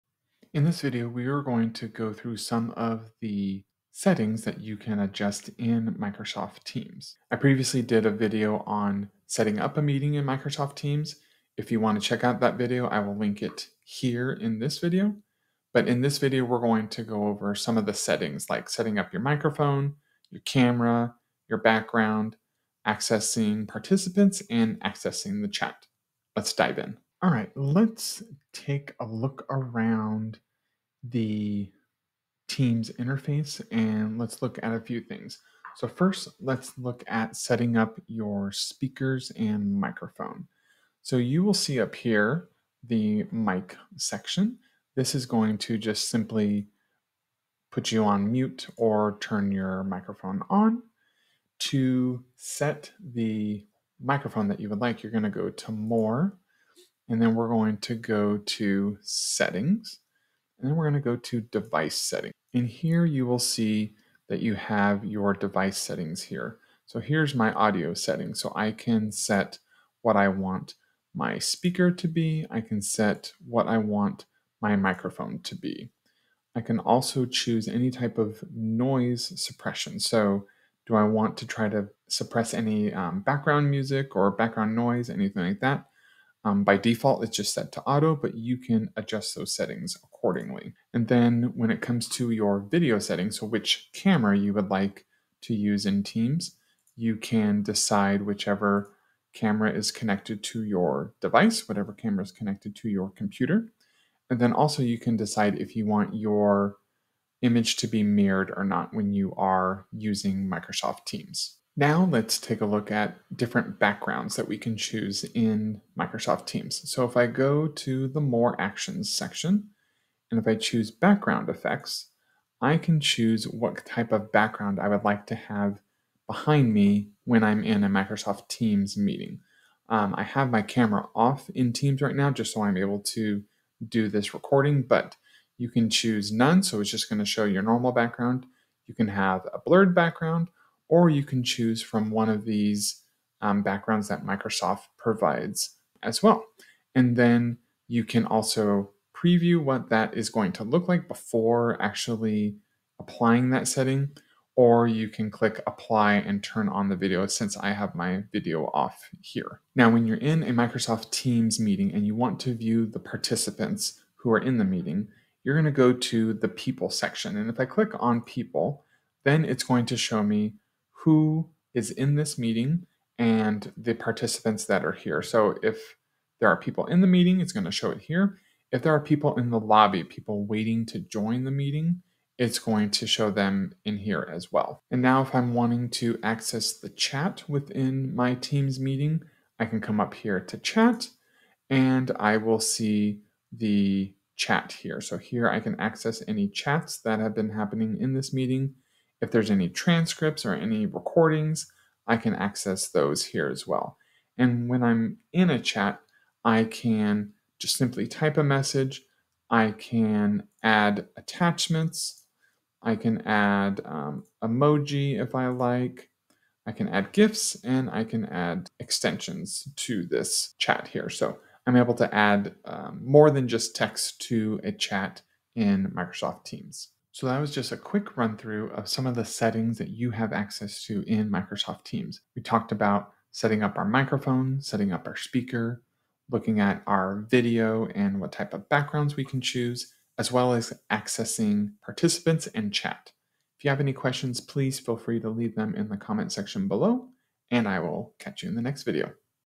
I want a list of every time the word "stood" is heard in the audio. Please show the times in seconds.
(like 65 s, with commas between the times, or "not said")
not said.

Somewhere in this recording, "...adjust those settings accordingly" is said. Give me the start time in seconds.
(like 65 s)
88 s.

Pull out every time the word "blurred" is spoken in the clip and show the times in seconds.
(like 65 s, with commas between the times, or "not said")
139 s.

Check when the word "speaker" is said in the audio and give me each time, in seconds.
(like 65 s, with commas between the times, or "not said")
38 s, 71 s, 235 s.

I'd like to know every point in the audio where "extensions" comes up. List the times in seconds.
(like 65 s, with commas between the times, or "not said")
218 s.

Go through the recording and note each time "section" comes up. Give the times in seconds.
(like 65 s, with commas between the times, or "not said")
43 s, 119 s, 166 s, 246 s.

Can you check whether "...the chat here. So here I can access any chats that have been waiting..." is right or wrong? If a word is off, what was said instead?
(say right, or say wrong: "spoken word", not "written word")
wrong: "happening", not "waiting".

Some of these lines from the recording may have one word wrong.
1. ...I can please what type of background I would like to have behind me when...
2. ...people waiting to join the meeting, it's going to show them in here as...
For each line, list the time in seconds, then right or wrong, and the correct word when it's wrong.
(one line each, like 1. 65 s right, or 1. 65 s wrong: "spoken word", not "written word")
1. 122 s wrong: "choose", not "please"
2. 180 s right.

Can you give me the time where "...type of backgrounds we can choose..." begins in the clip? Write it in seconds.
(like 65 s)
238 s.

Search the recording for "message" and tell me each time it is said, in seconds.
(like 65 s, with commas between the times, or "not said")
208 s.